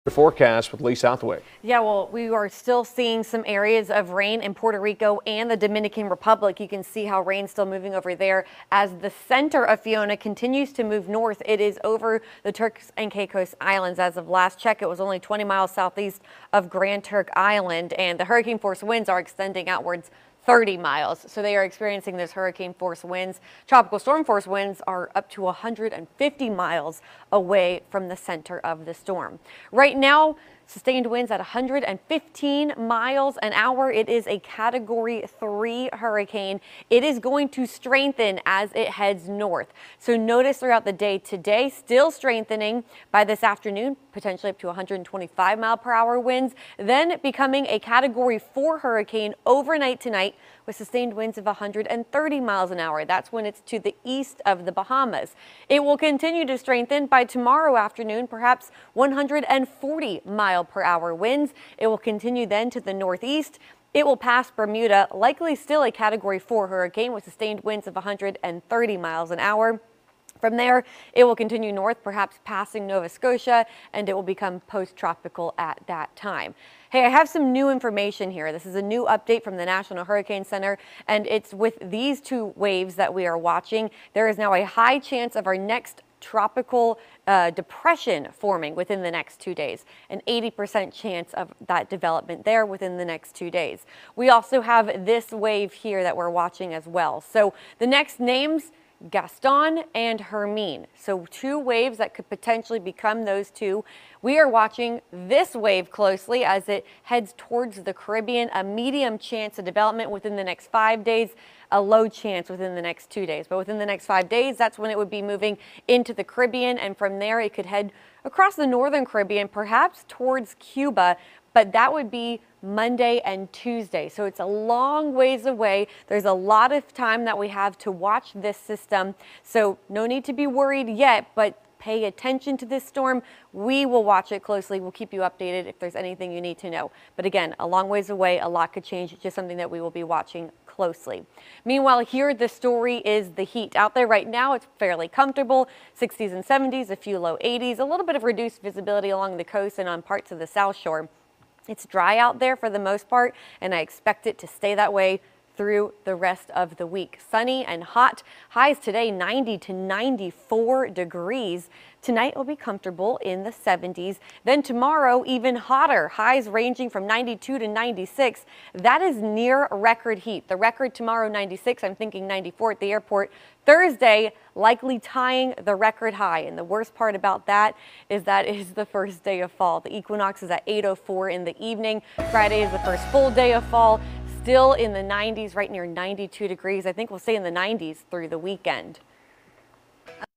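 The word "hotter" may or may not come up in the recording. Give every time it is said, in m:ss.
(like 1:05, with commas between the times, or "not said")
2:45.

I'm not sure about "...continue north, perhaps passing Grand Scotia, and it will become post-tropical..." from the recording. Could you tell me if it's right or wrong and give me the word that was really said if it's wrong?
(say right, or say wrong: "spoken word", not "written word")
wrong: "Nova", not "Grand".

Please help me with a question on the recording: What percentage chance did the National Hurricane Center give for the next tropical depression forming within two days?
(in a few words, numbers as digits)
80%.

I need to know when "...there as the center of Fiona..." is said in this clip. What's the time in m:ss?
0:08.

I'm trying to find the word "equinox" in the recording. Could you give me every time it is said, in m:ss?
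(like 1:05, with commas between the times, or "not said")
2:59.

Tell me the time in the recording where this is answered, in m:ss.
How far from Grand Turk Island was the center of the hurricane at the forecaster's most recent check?
0:15.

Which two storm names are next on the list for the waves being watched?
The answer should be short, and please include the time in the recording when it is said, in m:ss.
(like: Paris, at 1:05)
Gaston and Hermine, at 1:39.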